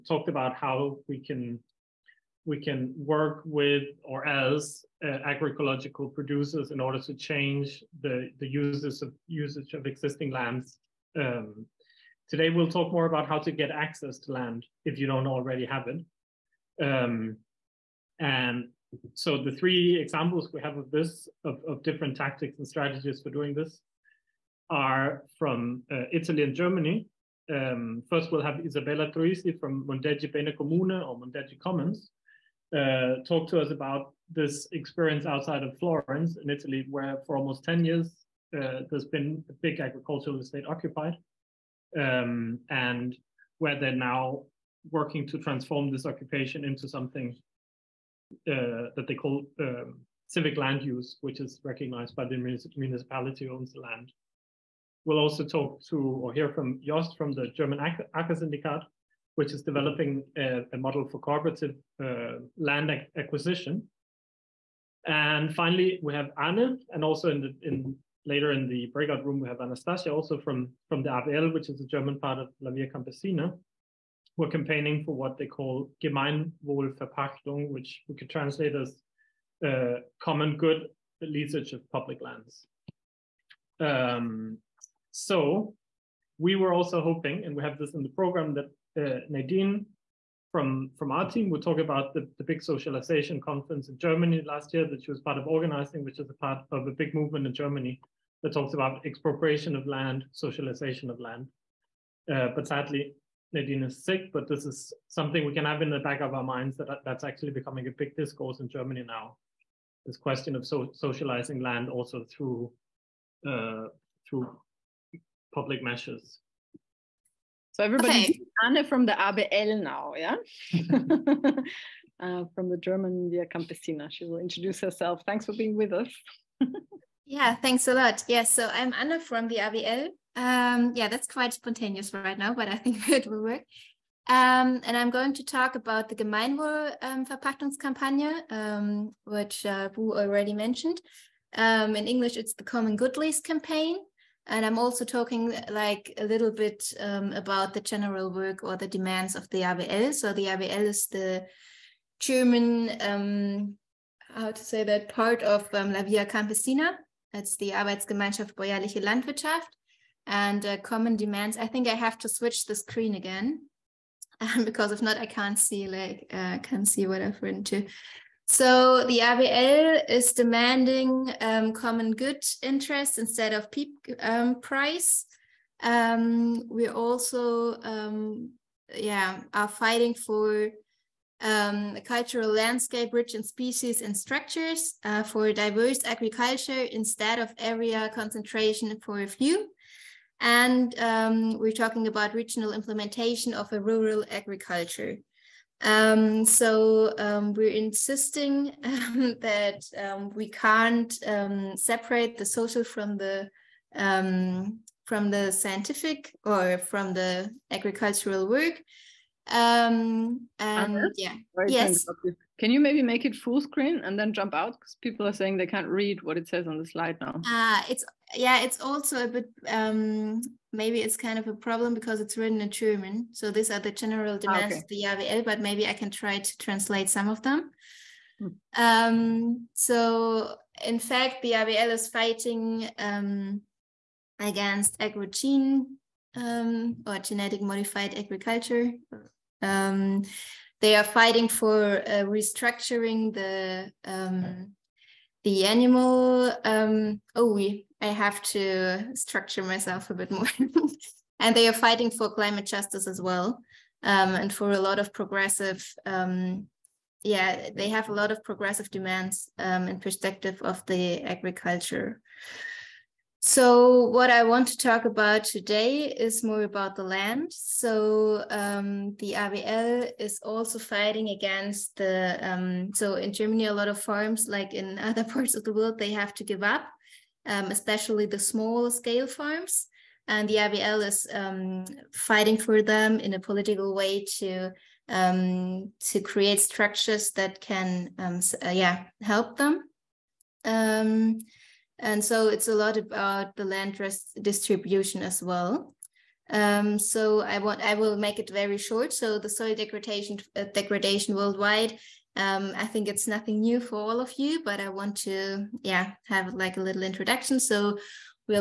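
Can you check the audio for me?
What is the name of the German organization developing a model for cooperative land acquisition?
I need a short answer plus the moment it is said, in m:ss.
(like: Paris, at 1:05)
Acker Syndikat, at 0:57.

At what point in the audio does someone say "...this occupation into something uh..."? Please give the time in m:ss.
0:45.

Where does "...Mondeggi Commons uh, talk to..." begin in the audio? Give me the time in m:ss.
0:31.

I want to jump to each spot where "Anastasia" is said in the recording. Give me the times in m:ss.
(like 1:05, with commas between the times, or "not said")
1:09.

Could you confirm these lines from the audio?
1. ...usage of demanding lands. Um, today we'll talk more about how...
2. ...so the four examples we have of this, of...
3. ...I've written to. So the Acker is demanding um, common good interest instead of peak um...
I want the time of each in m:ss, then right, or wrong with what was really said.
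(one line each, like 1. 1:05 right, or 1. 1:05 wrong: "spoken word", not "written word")
1. 0:09 wrong: "existing", not "demanding"
2. 0:19 wrong: "three", not "four"
3. 2:47 wrong: "ABL", not "Acker".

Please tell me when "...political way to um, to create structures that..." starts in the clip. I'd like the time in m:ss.
4:43.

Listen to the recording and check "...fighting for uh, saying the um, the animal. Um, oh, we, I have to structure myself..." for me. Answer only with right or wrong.
wrong.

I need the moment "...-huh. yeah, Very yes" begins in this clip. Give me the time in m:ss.
3:30.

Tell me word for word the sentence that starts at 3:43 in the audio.
So these are the general ah, demands okay.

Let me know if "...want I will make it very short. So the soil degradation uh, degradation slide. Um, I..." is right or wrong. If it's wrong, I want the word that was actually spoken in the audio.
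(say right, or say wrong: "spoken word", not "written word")
wrong: "worldwide", not "slide".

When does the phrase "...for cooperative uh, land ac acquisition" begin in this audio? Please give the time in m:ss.
1:01.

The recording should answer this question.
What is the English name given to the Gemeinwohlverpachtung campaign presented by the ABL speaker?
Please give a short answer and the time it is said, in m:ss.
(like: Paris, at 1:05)
Common Good Lease campaign, at 2:22.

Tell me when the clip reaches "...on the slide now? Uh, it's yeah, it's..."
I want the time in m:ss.
3:36.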